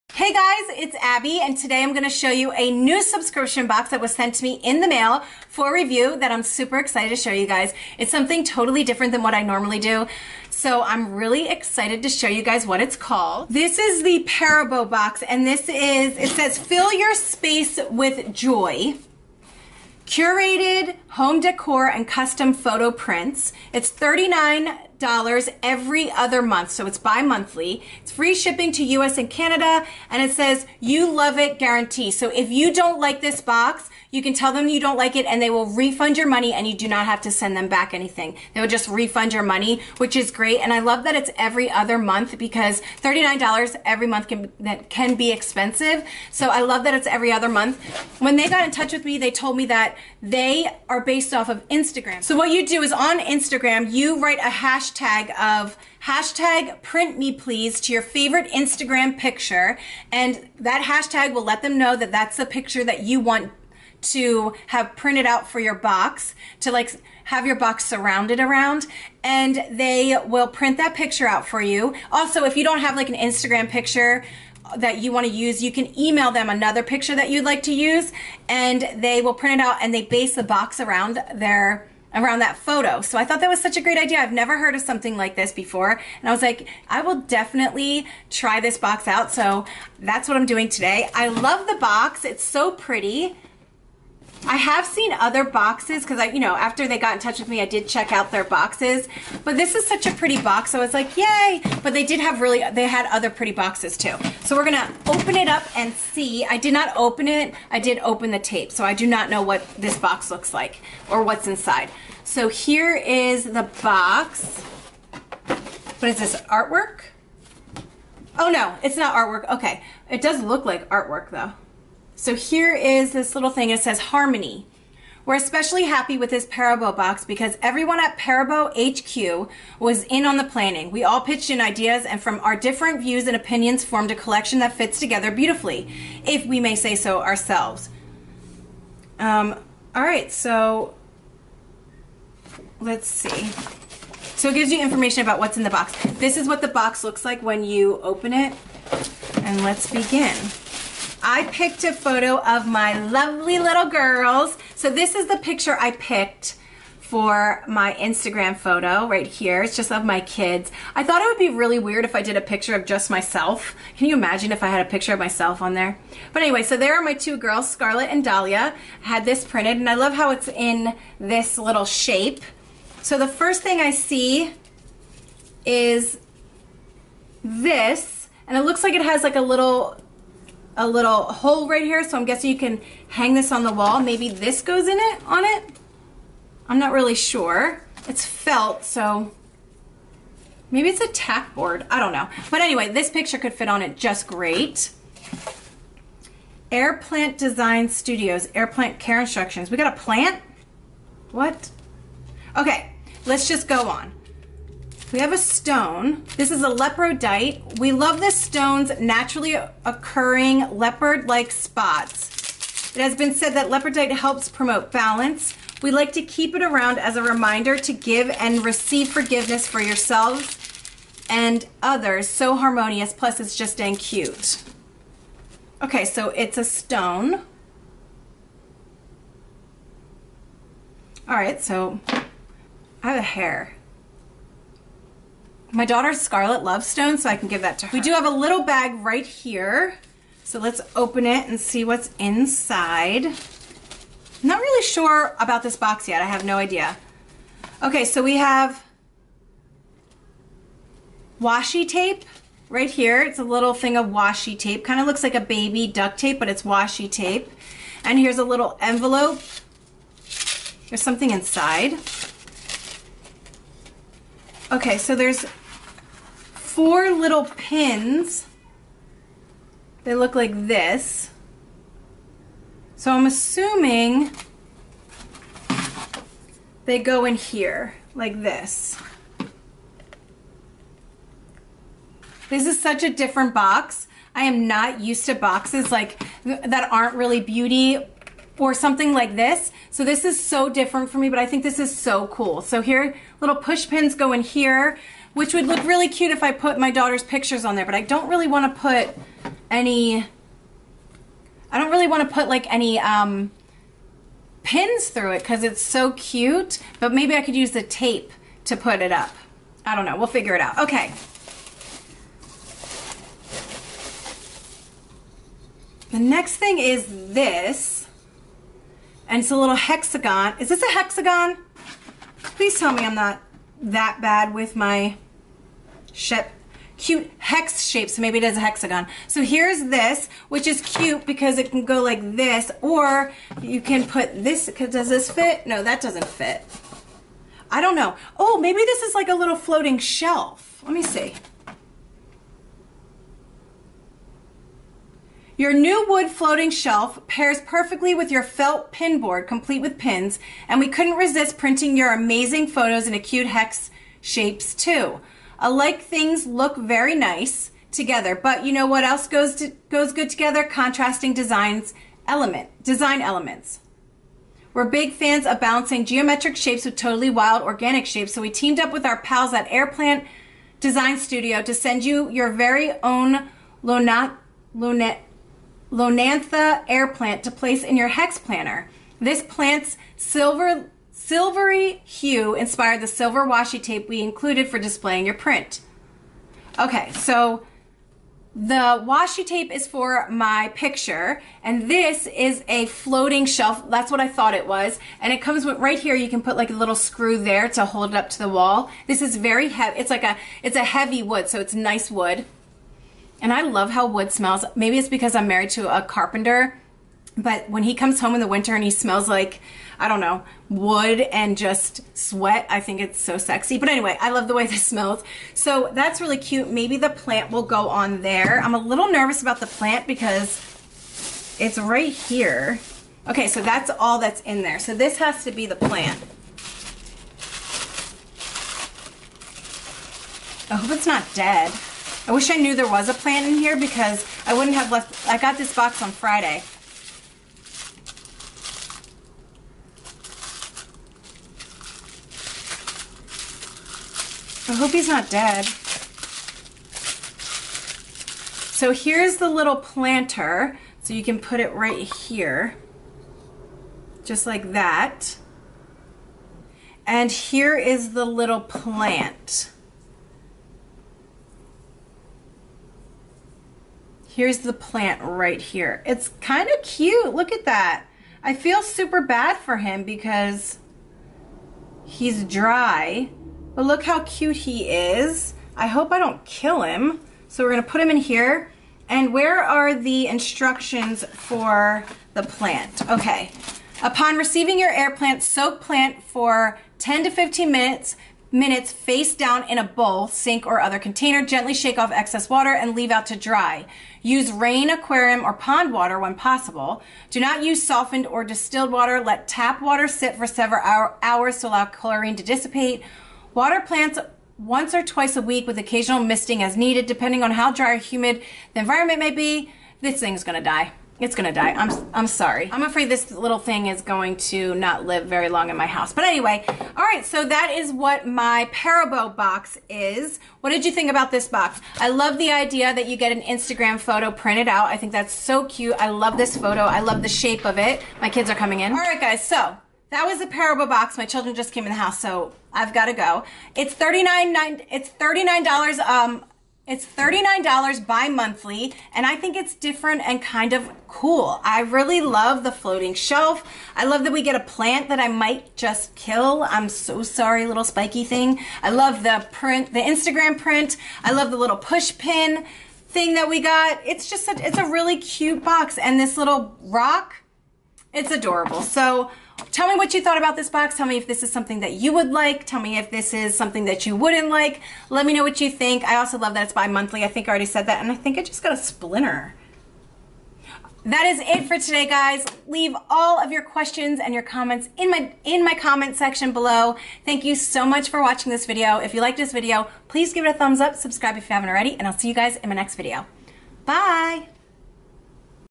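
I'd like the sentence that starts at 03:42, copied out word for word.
So harmonious, plus it's just dang cute.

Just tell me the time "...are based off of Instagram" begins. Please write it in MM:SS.
00:50.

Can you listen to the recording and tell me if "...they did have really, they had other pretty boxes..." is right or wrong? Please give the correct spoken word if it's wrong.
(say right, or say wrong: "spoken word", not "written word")
right.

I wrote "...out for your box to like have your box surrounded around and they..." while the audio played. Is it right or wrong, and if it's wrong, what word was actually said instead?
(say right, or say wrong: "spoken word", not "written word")
right.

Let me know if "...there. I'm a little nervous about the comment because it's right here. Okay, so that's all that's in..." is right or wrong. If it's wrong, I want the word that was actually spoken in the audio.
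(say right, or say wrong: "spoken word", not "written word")
wrong: "plant", not "comment".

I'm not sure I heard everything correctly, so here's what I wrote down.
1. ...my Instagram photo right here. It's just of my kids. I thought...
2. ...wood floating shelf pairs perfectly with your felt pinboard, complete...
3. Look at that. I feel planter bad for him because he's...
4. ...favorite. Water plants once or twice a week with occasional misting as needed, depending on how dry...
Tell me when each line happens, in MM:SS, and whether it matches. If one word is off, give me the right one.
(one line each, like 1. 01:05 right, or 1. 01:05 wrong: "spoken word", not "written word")
1. 02:37 right
2. 05:46 right
3. 07:47 wrong: "super", not "planter"
4. 08:22 wrong: "dissipate", not "favorite".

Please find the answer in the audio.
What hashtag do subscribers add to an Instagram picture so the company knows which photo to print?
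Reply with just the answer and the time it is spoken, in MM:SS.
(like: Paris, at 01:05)
print me please, at 00:56.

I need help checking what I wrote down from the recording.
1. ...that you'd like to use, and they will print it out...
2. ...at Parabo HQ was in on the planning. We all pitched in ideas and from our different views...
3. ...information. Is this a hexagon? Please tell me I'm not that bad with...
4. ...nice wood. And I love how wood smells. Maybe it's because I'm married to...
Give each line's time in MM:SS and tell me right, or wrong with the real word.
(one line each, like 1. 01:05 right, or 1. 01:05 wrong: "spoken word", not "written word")
1. 01:17 right
2. 02:07 right
3. 05:19 wrong: "hexagon", not "information"
4. 06:41 right.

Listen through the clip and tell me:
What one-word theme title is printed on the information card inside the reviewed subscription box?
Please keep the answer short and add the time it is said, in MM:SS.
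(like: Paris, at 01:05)
Harmony, at 02:03.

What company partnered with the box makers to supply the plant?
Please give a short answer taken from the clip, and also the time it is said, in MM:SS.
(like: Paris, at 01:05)
Airplant Design Studio, at 06:09.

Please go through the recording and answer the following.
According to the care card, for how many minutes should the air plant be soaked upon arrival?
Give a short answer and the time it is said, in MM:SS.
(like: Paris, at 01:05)
10 to 15 minutes, at 08:06.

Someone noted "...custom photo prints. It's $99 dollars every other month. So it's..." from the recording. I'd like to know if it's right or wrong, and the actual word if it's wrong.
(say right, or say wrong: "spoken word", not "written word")
wrong: "39", not "99".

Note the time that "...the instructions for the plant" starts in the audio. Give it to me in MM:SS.
07:59.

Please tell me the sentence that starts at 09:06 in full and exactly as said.
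I'm so sorry, little spiky thing.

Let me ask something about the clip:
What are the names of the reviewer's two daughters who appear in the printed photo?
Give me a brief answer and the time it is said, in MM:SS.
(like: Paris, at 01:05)
Scarlett and Dahlia, at 02:47.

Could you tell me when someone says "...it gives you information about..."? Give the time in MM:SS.
02:24.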